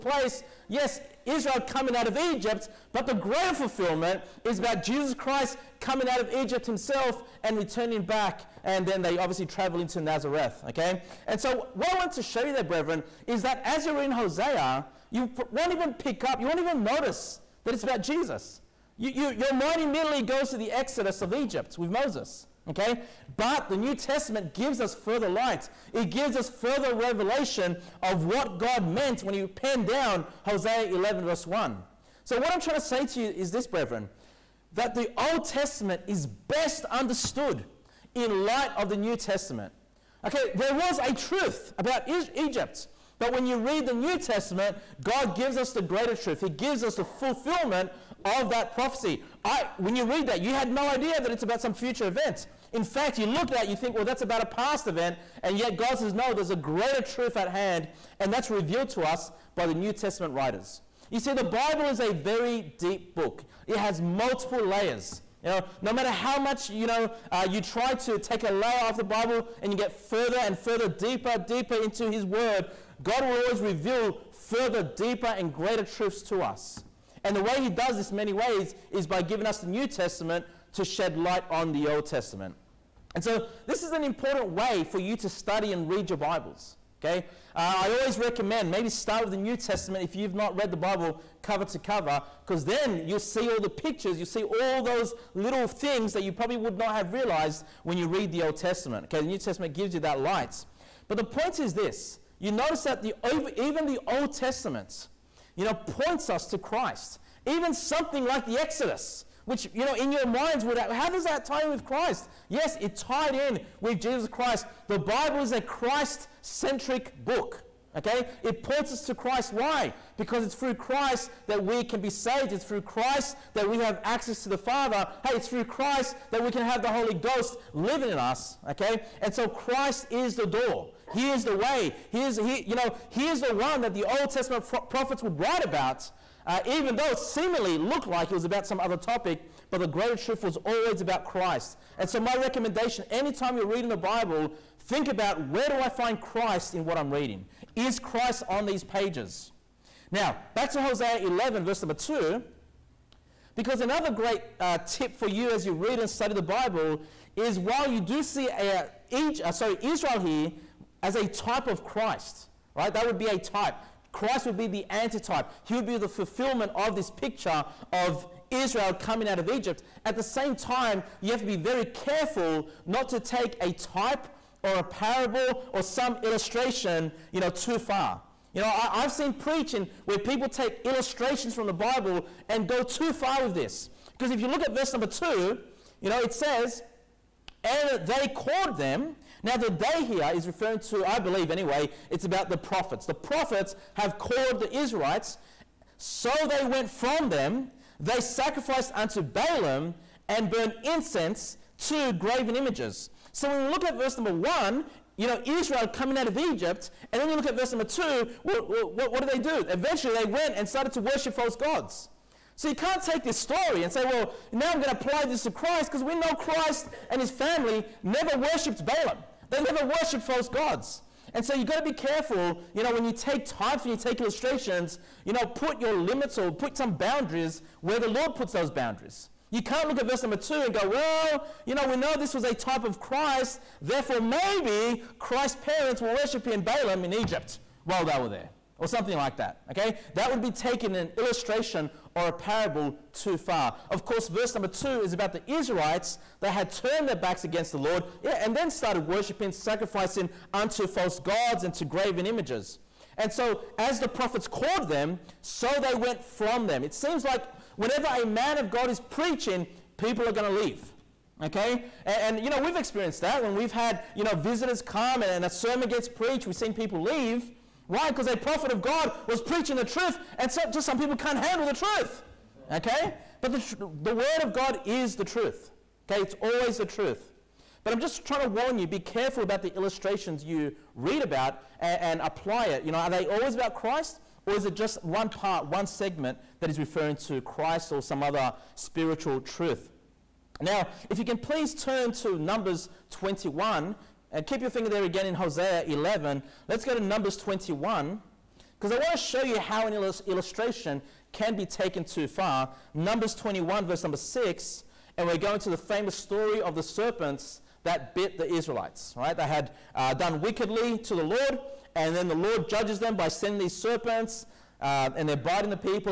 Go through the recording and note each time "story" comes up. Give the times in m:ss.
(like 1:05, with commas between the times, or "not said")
3:33, 5:06.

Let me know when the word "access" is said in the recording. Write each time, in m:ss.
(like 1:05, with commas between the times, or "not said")
2:04.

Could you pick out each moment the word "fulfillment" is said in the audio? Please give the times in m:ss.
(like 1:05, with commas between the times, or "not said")
0:03, 0:47, 2:46.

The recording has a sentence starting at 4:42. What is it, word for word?
You know, are they always about Christ?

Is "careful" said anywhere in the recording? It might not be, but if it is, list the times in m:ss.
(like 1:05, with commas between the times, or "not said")
2:51, 3:41, 4:38.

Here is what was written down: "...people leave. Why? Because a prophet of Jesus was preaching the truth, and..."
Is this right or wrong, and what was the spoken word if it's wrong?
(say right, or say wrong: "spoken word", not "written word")
wrong: "God", not "Jesus".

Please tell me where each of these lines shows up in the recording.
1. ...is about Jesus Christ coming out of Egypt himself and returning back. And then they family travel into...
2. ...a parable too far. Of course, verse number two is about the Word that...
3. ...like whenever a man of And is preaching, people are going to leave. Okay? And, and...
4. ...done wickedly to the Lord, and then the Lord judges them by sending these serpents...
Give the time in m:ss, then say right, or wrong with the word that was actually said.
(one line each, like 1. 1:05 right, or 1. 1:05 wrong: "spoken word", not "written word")
1. 0:04 wrong: "obviously", not "family"
2. 4:02 wrong: "Israelites", not "Word"
3. 4:17 wrong: "God", not "And"
4. 5:10 right.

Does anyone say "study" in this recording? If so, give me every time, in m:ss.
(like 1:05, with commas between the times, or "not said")
1:25, 2:36.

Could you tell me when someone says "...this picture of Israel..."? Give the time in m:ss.
2:46.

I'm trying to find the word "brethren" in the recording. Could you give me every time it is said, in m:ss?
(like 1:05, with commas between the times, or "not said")
0:12, 0:33.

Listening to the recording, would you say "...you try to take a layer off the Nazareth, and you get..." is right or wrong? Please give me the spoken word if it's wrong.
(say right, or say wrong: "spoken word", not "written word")
wrong: "Bible", not "Nazareth".